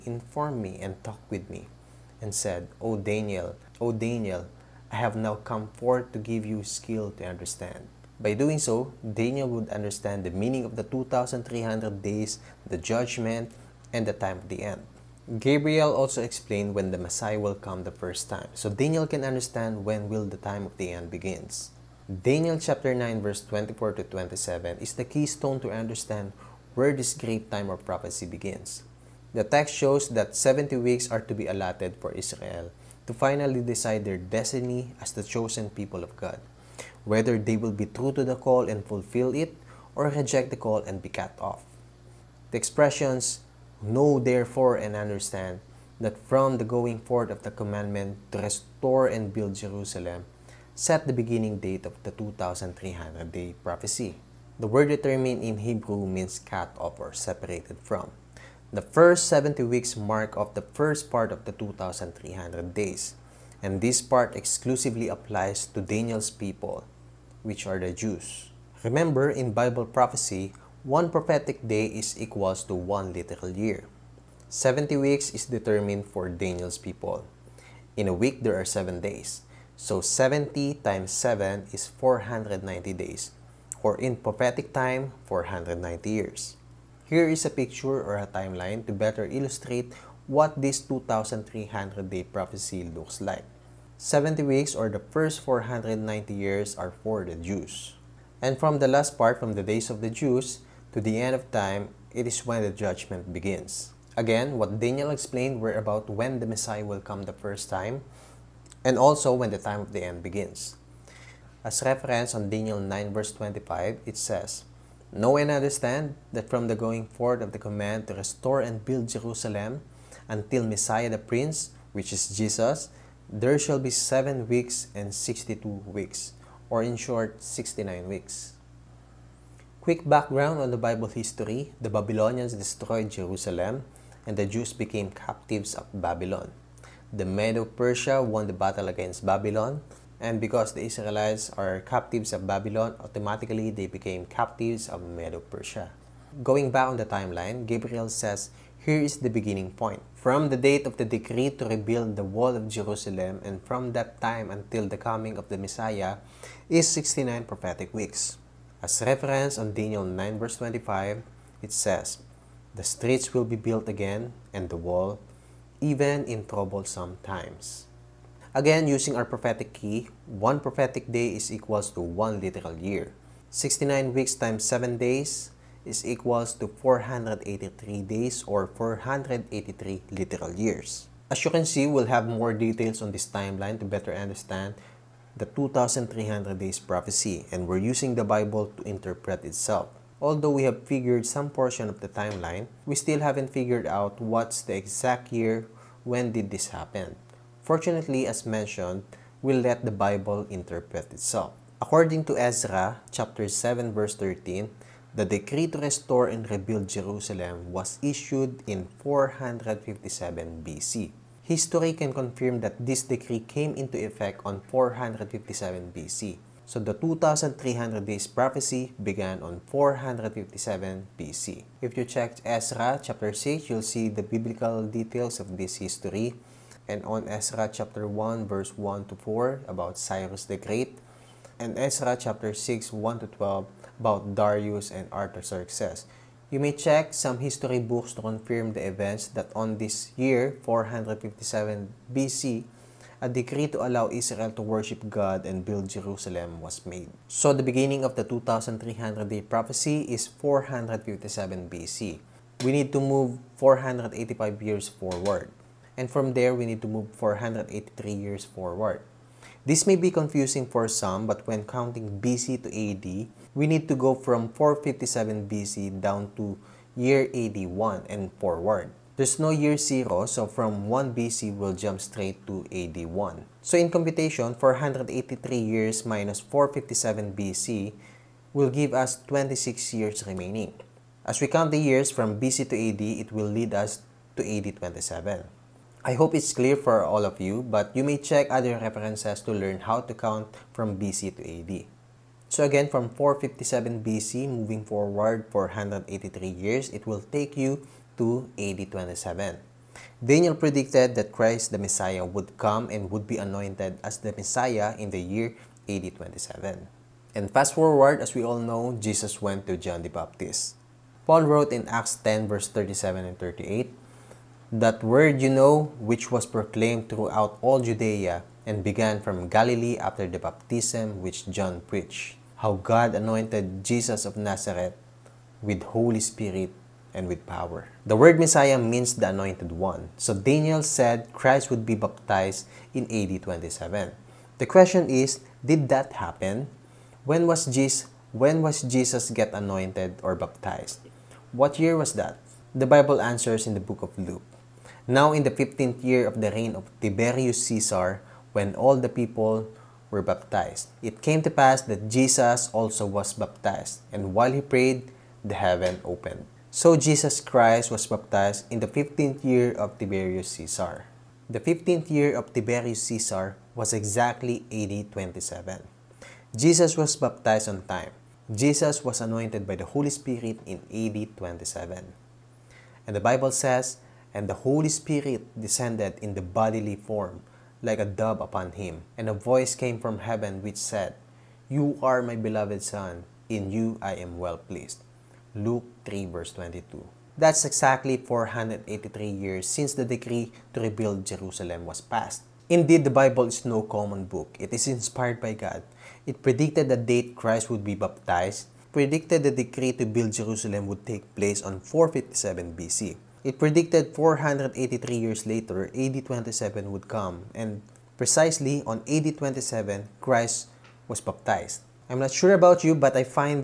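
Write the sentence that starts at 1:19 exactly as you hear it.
So 70 times 7 is 490 days, or in prophetic time, 490 years.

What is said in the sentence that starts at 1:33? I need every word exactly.
70 weeks or the first 490 years are for the Jews.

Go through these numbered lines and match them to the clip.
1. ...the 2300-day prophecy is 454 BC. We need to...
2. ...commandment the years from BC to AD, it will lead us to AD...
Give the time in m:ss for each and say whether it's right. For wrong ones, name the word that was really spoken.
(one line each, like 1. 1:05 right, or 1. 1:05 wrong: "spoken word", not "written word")
1. 4:08 wrong: "457", not "454"
2. 4:41 wrong: "count", not "commandment".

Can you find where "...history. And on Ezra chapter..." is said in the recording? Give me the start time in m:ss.
3:45.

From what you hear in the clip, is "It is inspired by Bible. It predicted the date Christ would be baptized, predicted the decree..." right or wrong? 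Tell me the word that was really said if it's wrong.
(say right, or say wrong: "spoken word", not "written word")
wrong: "God", not "Bible".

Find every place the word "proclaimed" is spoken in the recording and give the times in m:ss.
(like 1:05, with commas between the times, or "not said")
5:16.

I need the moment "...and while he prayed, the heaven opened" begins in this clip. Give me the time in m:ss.
5:54.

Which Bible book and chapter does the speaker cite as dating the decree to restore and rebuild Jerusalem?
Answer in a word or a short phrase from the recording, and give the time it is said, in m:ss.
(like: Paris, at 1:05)
Ezra chapter 7, at 3:22.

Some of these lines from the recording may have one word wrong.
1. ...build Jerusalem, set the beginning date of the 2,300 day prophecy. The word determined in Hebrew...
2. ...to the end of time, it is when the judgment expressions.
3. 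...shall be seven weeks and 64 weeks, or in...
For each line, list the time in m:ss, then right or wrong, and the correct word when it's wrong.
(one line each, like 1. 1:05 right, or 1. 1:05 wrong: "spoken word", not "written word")
1. 0:49 right
2. 1:40 wrong: "begins", not "expressions"
3. 2:03 wrong: "62", not "64".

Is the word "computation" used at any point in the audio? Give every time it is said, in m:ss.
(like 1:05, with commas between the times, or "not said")
4:33.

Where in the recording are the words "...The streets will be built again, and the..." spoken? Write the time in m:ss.
2:42.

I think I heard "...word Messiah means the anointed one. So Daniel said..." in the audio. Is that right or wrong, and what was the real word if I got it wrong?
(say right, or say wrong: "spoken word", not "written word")
right.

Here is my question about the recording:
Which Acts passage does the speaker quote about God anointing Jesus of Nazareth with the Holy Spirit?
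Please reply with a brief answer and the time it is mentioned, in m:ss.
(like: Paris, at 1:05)
Acts 10:37-38, at 5:11.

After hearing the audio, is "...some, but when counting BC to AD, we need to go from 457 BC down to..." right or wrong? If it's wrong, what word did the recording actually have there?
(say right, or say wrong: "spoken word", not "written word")
right.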